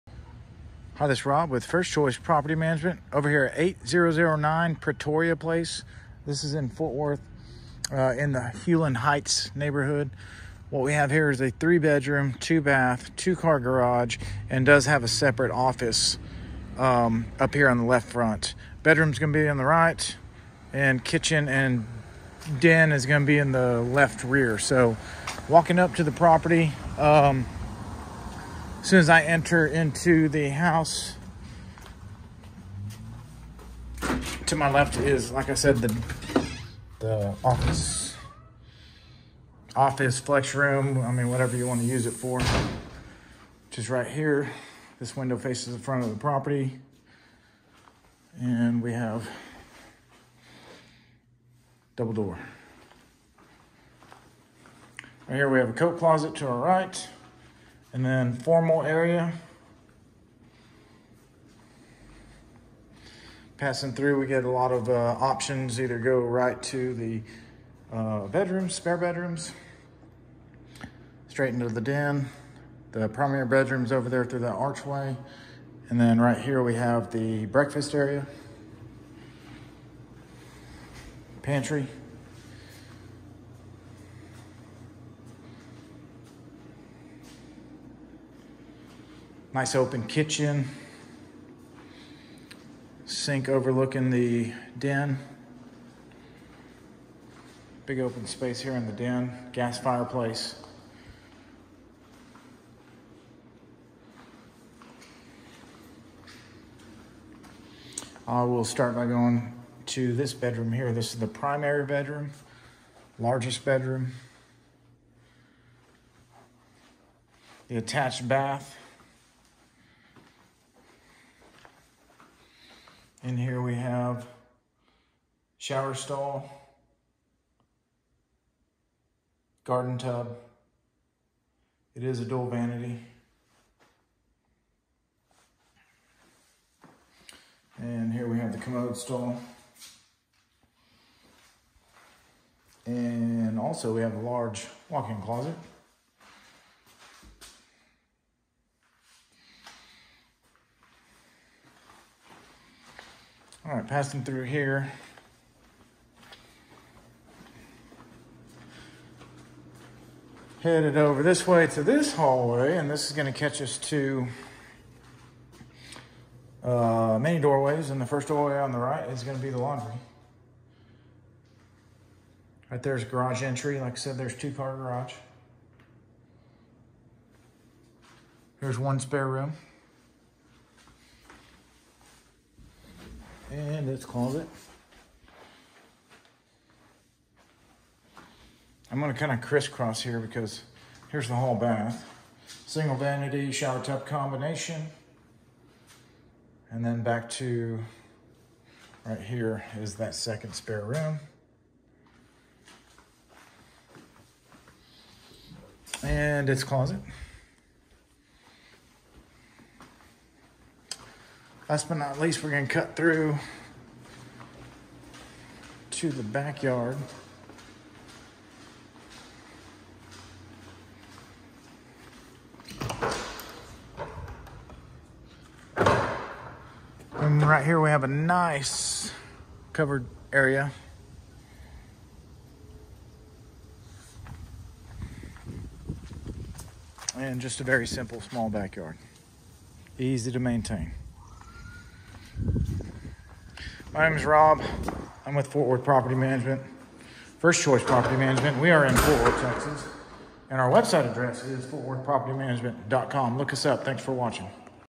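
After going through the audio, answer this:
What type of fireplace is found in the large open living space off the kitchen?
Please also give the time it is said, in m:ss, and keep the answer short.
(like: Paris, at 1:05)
Gas, at 1:39.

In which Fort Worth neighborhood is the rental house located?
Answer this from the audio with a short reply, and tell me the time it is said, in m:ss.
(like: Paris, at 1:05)
Hulen Heights, at 0:08.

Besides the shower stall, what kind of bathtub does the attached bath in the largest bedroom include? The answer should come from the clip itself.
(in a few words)
Garden tub.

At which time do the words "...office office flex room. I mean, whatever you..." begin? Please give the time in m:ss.
0:37.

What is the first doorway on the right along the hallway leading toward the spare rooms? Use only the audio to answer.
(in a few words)
Laundry.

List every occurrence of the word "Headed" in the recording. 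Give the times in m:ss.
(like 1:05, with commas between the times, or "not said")
2:40.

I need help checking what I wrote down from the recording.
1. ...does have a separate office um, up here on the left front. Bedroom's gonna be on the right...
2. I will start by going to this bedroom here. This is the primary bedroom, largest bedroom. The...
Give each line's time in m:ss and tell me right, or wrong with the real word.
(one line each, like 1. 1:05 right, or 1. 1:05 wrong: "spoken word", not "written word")
1. 0:14 right
2. 1:48 right.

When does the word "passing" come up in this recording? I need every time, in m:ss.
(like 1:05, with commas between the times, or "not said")
1:03, 2:33.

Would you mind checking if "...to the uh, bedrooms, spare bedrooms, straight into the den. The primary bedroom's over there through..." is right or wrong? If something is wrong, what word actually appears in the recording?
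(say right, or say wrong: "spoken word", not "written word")
right.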